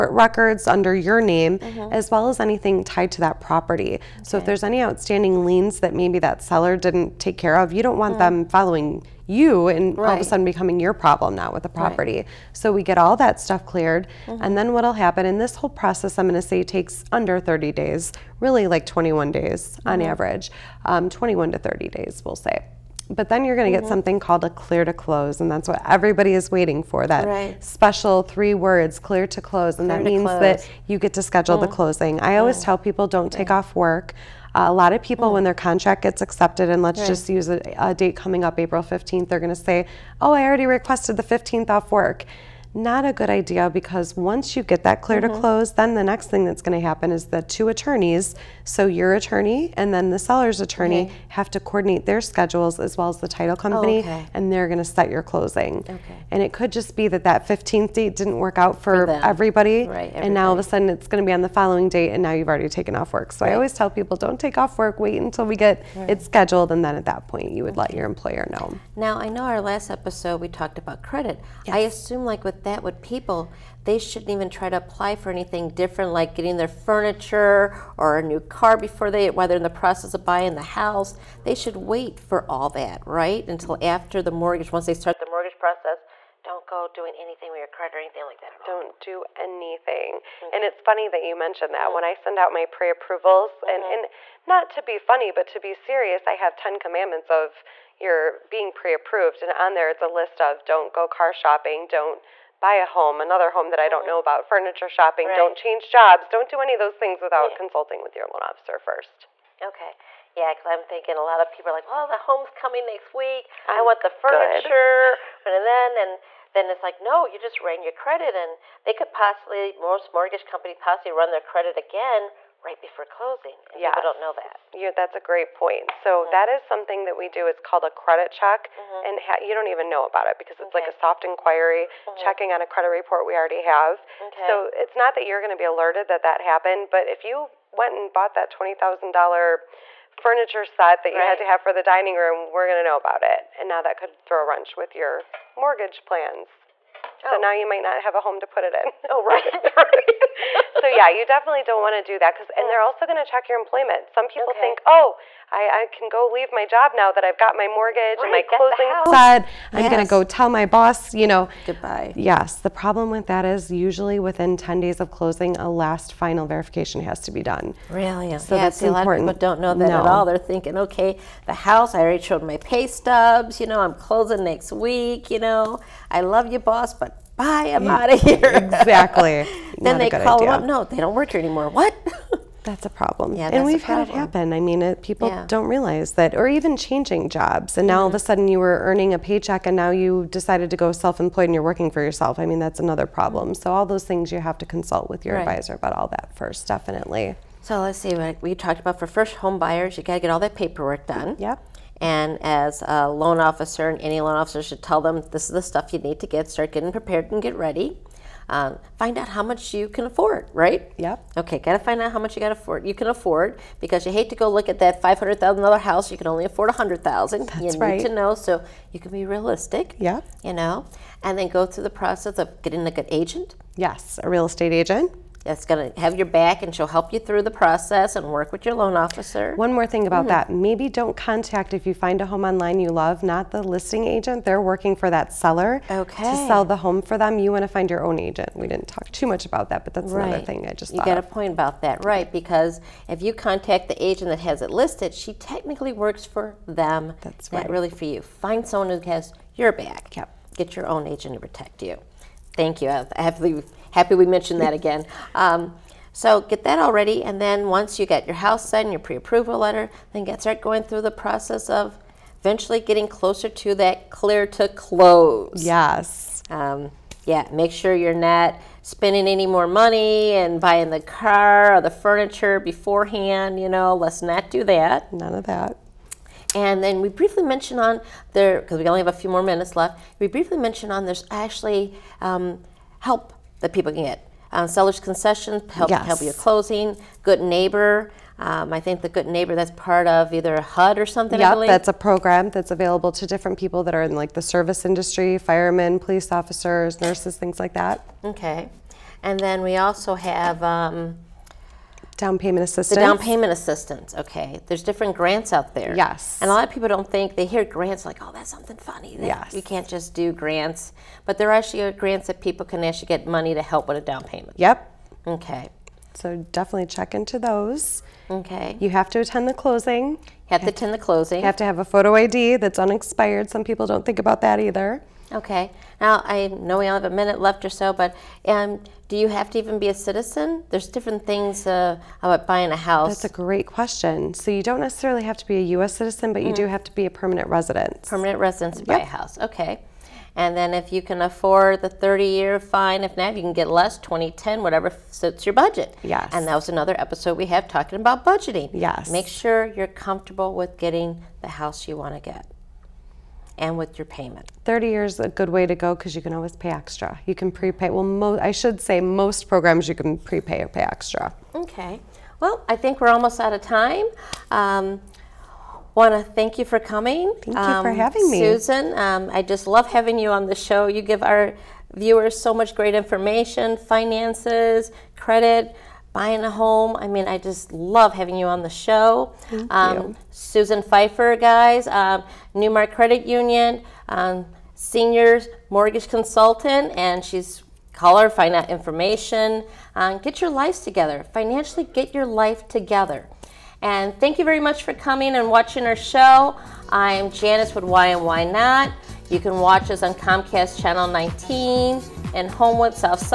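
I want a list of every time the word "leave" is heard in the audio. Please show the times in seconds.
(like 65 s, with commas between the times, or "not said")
156 s.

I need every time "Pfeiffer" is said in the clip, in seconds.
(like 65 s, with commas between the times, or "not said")
380 s.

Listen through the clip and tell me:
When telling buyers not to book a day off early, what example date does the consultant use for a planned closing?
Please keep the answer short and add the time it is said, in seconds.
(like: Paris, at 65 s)
April 15th, at 38 s.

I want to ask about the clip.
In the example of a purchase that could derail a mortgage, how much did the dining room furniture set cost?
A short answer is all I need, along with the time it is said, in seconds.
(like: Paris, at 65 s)
$20,000, at 138 s.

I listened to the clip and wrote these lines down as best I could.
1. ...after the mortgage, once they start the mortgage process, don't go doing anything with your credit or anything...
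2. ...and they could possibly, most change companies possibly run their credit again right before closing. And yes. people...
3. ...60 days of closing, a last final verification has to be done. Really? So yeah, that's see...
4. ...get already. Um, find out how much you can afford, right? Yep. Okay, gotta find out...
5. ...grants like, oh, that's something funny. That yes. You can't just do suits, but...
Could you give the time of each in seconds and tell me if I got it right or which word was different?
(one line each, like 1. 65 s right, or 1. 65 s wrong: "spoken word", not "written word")
1. 83 s right
2. 118 s wrong: "mortgage", not "change"
3. 164 s wrong: "10", not "60"
4. 207 s wrong: "ready", not "already"
5. 307 s wrong: "grants", not "suits".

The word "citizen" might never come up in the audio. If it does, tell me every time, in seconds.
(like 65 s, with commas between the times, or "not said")
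329 s, 335 s.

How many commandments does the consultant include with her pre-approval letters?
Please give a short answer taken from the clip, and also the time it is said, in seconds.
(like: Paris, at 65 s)
10, at 96 s.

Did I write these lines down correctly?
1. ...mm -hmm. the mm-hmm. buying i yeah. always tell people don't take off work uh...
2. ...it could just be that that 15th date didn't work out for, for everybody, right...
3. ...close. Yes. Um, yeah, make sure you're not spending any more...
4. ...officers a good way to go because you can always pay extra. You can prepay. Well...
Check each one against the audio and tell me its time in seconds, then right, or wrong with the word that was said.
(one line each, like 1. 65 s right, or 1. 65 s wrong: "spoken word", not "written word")
1. 31 s wrong: "closing", not "buying"
2. 56 s right
3. 264 s right
4. 354 s wrong: "years", not "officers".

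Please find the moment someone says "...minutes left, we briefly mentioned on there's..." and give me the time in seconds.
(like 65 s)
279 s.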